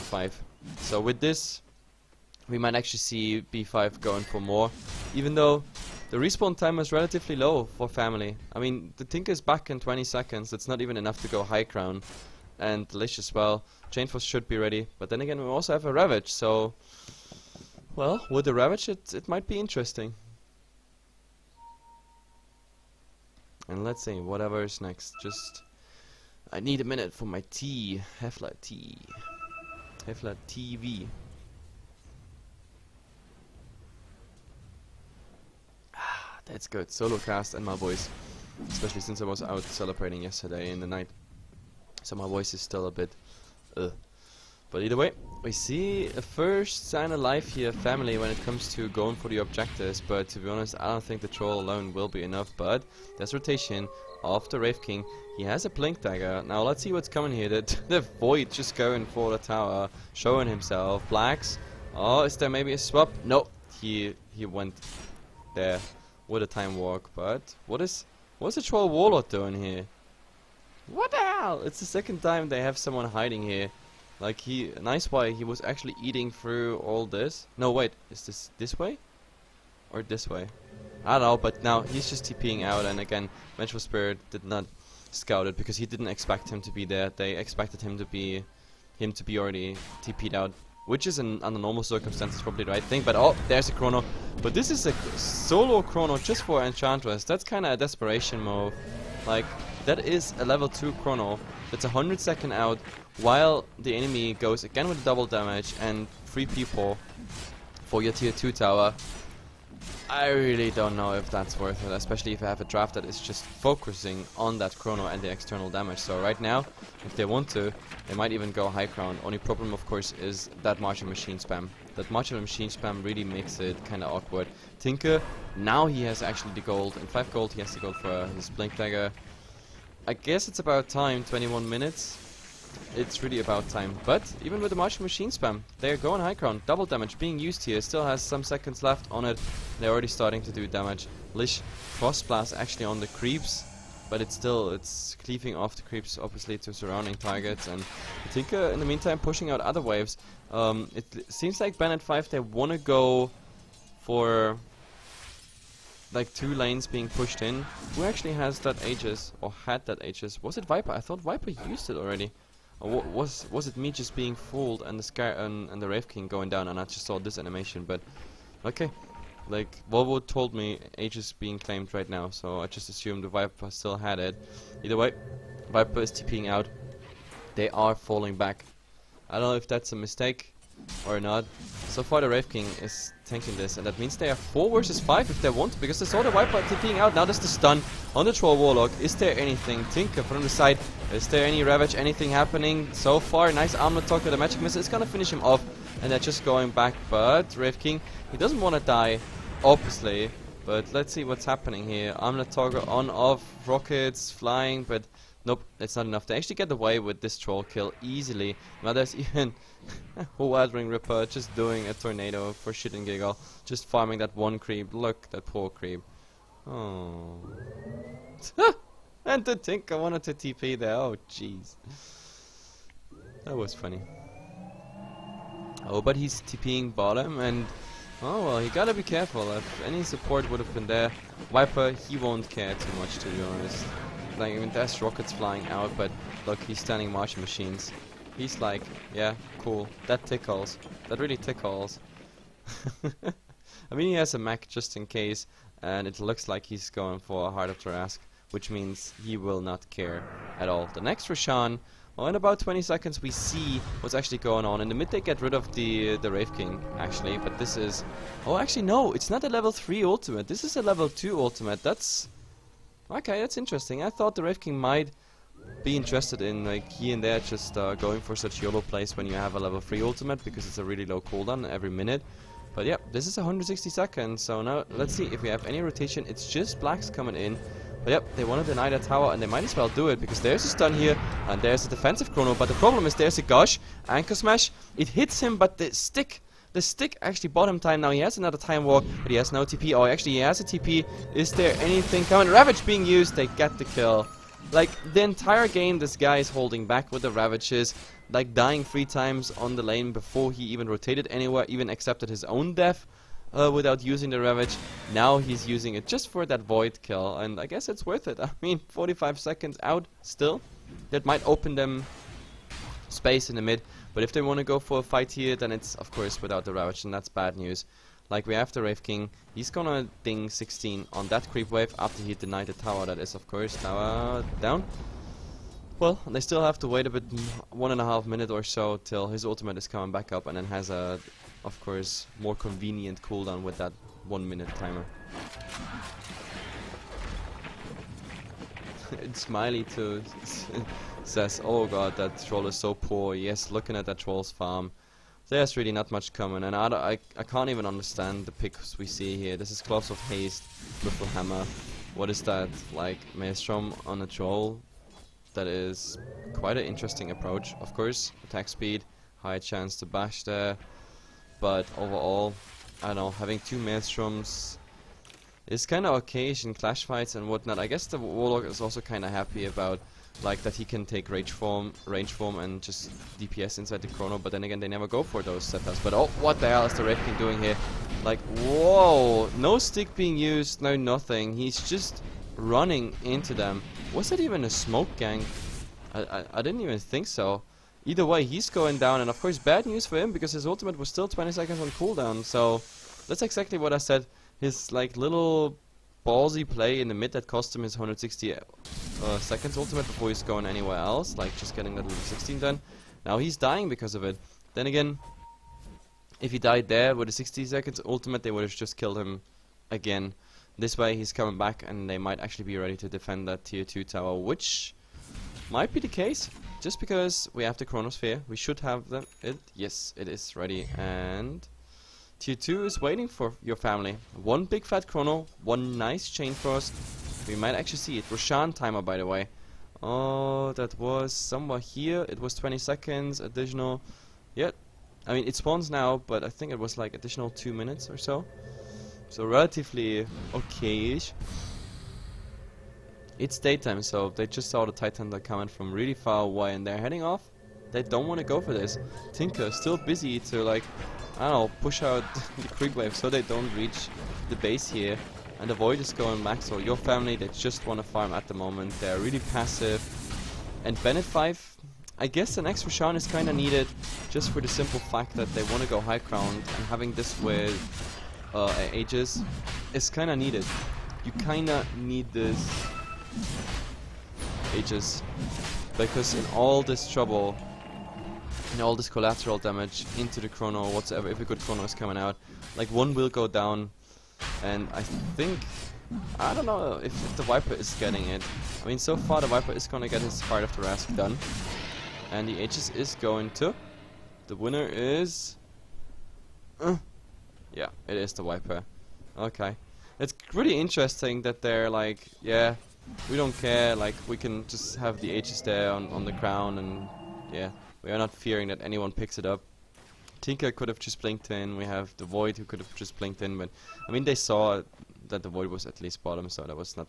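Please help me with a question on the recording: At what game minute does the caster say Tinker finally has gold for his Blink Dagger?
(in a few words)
21 minutes.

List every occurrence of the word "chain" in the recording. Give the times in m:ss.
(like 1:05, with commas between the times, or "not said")
0:13, 7:06.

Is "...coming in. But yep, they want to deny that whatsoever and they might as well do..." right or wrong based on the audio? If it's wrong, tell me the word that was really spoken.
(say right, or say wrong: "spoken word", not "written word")
wrong: "tower", not "whatsoever".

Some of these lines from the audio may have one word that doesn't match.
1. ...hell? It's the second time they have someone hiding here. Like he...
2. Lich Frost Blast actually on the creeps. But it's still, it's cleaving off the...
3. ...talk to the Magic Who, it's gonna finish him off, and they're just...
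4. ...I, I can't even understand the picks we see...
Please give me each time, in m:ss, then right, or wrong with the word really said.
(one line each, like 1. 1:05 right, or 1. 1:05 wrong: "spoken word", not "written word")
1. 1:11 right
2. 2:21 right
3. 3:14 wrong: "Missile", not "Who"
4. 5:46 right.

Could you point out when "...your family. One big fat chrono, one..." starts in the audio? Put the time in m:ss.
7:03.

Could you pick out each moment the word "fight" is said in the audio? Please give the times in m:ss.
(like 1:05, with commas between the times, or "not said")
5:15, 6:07.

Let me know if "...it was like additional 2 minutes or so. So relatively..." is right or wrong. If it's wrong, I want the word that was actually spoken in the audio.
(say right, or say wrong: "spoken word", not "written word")
right.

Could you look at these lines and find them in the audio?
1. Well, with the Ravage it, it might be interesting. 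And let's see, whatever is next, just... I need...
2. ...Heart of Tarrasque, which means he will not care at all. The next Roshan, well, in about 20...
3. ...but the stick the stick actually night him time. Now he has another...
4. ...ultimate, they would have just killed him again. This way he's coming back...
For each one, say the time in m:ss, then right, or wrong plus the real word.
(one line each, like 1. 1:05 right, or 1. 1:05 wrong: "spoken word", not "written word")
1. 0:17 right
2. 4:07 right
3. 4:45 wrong: "bought", not "night"
4. 6:48 right.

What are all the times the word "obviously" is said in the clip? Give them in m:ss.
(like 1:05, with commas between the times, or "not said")
2:26, 3:19.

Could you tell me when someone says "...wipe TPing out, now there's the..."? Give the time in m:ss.
3:06.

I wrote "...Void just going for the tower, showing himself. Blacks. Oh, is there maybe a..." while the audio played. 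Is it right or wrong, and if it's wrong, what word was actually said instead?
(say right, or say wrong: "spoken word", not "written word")
right.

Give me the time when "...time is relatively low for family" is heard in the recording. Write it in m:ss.
0:06.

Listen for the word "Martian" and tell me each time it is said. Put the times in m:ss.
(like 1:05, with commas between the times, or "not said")
2:14, 3:57.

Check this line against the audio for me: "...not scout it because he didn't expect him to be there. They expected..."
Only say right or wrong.
right.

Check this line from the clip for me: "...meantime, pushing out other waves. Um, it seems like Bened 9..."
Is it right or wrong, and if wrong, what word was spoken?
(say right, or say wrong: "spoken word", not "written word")
wrong: "5", not "9".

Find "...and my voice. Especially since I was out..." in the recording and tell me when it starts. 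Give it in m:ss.
0:37.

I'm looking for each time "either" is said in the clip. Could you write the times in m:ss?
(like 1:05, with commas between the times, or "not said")
0:44, 2:54, 6:28.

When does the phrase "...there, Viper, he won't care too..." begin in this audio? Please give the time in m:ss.
3:50.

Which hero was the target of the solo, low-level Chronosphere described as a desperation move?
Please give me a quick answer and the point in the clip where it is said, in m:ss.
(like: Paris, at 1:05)
Enchantress, at 1:36.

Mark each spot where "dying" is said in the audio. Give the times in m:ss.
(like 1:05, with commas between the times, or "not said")
4:58, 6:43.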